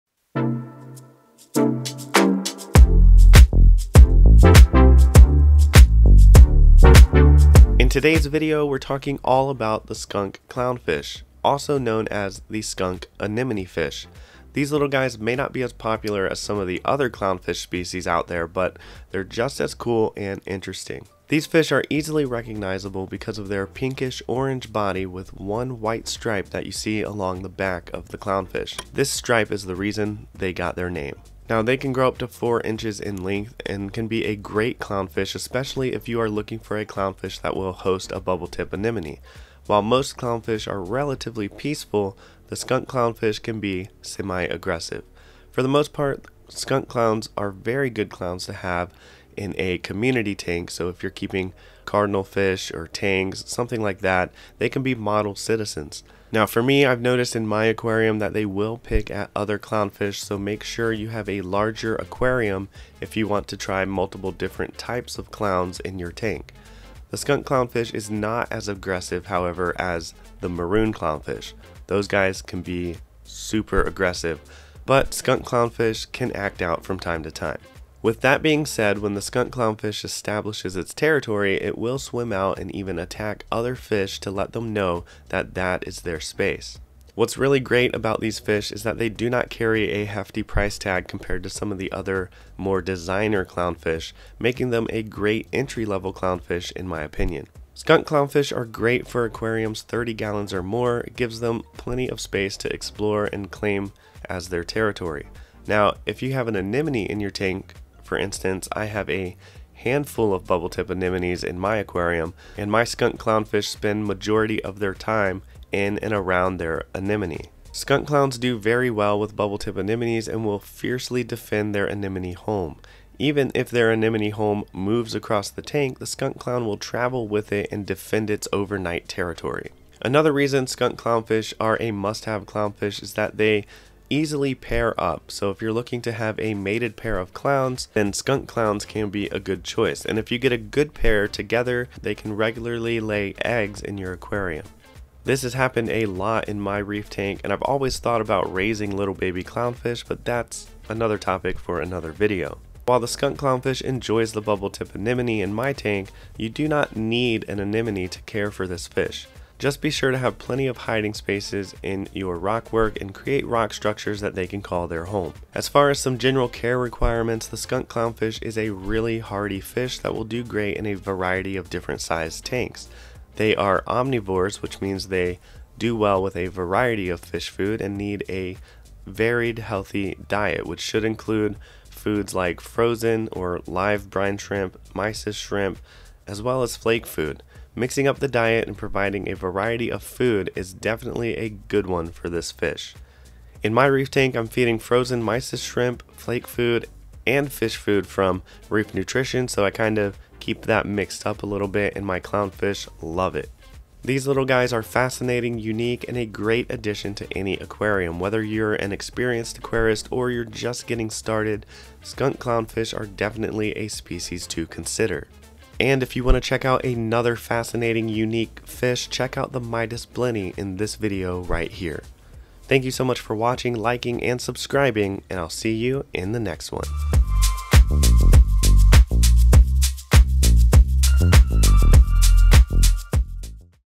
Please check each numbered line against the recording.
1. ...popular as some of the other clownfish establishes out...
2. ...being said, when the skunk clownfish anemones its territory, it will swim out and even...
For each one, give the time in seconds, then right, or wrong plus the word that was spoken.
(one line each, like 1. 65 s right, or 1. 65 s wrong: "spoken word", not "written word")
1. 15 s wrong: "species", not "establishes"
2. 78 s wrong: "establishes", not "anemones".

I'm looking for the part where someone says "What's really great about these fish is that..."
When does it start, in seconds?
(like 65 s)
87 s.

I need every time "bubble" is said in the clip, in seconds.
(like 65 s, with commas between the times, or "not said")
38 s, 110 s, 119 s, 154 s.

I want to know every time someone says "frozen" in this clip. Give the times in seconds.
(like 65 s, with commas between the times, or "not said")
182 s, 194 s.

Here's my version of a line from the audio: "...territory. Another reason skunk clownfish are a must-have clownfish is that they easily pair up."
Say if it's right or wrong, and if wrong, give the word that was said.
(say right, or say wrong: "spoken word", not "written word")
right.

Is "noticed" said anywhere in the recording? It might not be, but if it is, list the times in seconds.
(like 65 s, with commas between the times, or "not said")
57 s.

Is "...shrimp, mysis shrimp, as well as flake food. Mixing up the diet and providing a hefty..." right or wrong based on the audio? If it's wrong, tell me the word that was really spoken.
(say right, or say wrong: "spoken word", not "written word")
wrong: "variety", not "hefty".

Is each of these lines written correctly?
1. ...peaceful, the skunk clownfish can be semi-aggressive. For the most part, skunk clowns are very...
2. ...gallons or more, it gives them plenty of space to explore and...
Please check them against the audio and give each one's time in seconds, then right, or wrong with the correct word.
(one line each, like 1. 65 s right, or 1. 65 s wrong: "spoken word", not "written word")
1. 41 s right
2. 100 s right.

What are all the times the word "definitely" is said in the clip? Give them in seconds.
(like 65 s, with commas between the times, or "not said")
190 s, 213 s.